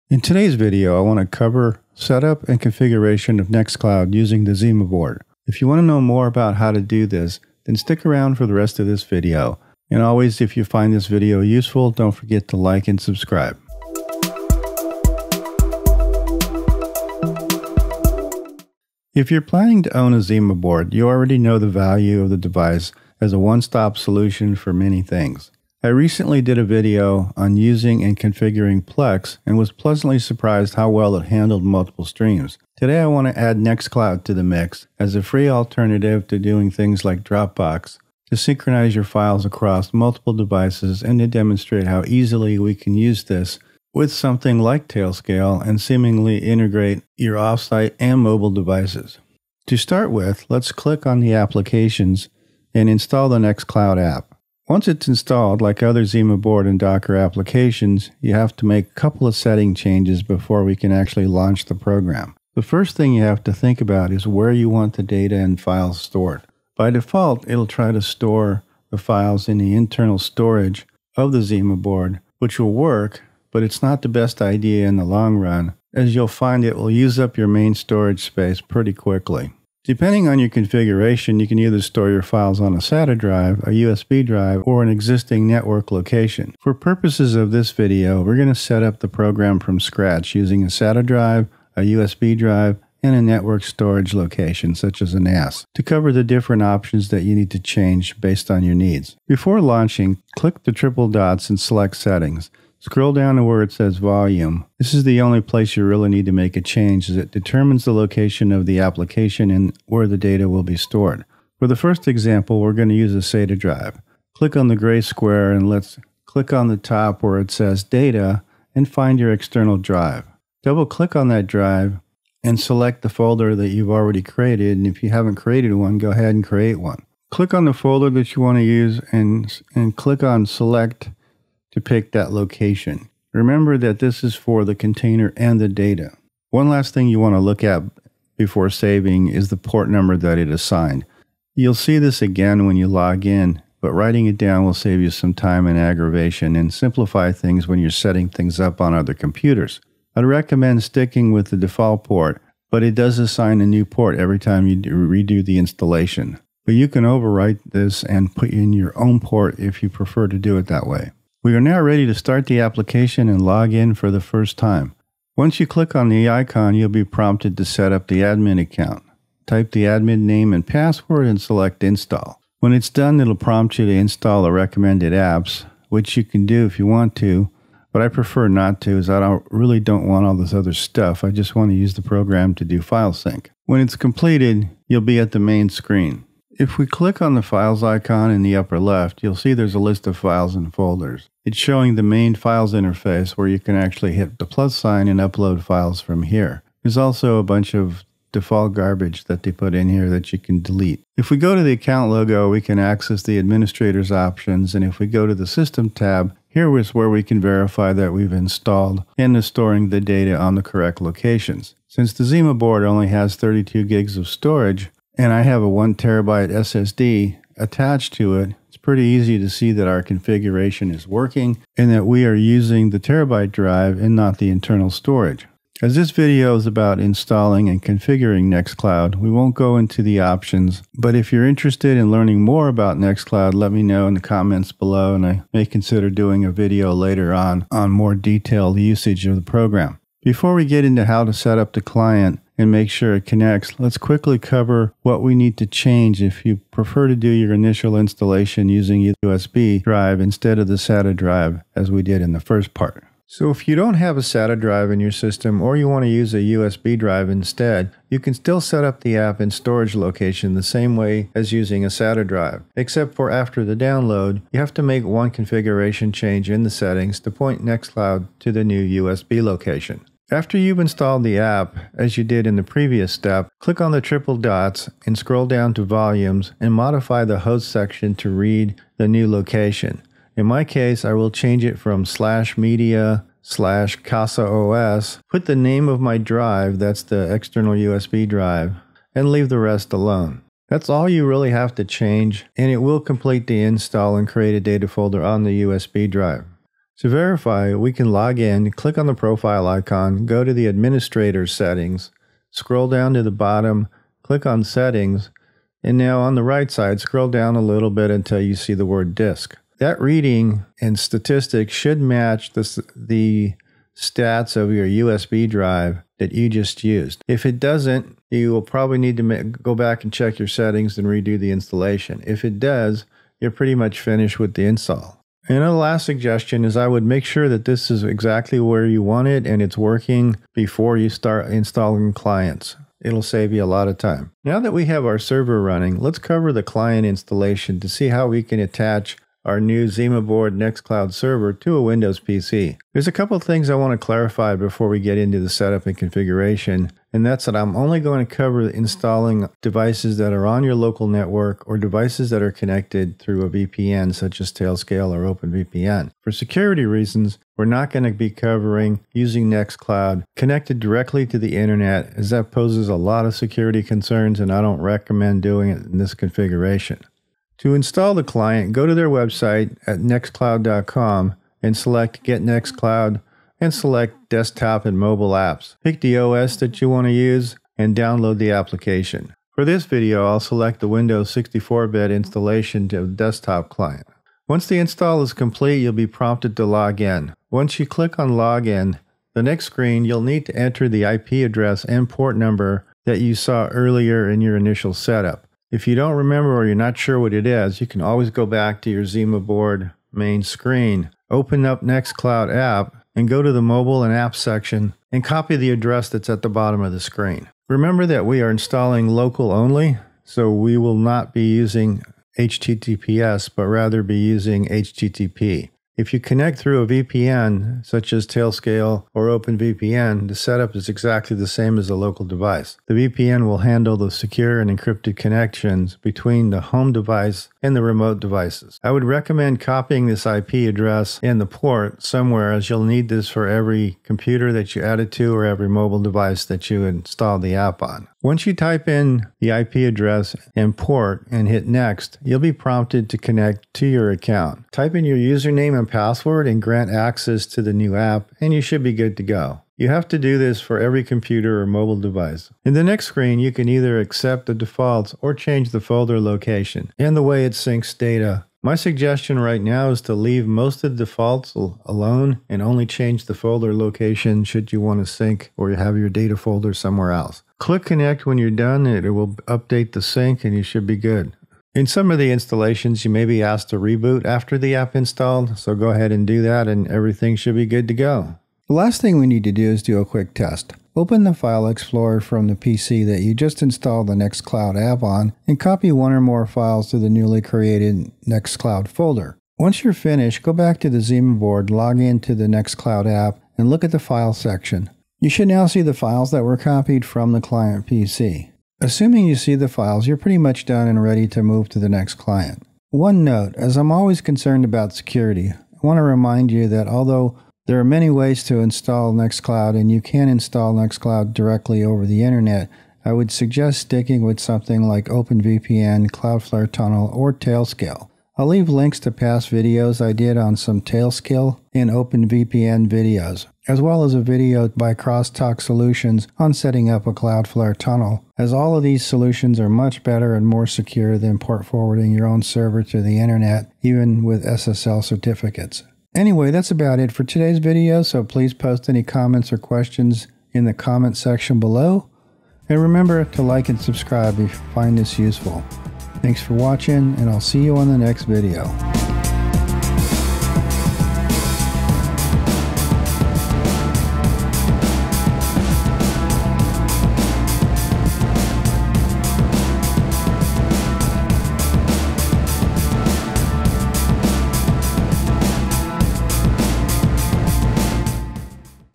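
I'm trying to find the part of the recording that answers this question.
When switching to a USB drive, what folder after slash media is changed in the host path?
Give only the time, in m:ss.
4:43.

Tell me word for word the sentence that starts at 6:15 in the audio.
Pick the OS that you want to use and download the application.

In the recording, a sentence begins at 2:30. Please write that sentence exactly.
I'd recommend sticking with the default port, but it does assign a new port every time you redo the installation.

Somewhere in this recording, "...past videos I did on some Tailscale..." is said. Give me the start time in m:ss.
8:39.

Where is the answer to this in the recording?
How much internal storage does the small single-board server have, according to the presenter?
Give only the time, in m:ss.
3:33.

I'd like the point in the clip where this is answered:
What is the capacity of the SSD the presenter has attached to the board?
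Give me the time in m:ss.
3:35.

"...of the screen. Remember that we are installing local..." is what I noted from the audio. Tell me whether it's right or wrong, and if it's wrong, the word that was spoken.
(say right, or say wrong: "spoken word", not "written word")
right.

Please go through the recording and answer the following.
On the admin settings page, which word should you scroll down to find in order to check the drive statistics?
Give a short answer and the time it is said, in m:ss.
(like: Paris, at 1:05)
disk, at 5:09.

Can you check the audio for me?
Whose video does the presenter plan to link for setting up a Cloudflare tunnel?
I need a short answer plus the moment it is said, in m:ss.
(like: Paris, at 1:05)
Crosstalk Solutions, at 8:44.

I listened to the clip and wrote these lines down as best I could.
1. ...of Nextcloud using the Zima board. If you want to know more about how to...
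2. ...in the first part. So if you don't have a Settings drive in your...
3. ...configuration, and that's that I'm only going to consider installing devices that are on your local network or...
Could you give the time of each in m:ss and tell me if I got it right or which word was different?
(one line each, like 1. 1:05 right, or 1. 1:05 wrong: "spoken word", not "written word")
1. 0:03 right
2. 4:12 wrong: "SATA", not "Settings"
3. 5:45 wrong: "cover", not "consider".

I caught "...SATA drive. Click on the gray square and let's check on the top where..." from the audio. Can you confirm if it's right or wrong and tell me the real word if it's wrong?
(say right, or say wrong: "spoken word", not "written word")
wrong: "click", not "check".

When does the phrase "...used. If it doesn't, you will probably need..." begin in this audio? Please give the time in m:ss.
5:16.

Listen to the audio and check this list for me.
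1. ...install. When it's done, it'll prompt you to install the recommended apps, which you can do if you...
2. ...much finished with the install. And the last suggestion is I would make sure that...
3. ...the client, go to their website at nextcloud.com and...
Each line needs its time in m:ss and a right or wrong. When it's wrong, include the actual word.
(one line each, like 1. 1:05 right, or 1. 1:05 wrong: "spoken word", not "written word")
1. 2:51 right
2. 5:23 right
3. 6:08 right.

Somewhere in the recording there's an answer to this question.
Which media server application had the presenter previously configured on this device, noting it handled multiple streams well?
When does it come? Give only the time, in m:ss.
0:28.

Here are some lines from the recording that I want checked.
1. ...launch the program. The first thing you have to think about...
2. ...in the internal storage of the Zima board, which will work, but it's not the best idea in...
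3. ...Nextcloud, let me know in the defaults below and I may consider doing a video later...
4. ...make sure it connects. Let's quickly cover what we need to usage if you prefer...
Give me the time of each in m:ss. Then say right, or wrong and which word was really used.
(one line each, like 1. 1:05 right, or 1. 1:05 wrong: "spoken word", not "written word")
1. 1:01 right
2. 1:09 right
3. 3:52 wrong: "comments", not "defaults"
4. 4:02 wrong: "change", not "usage".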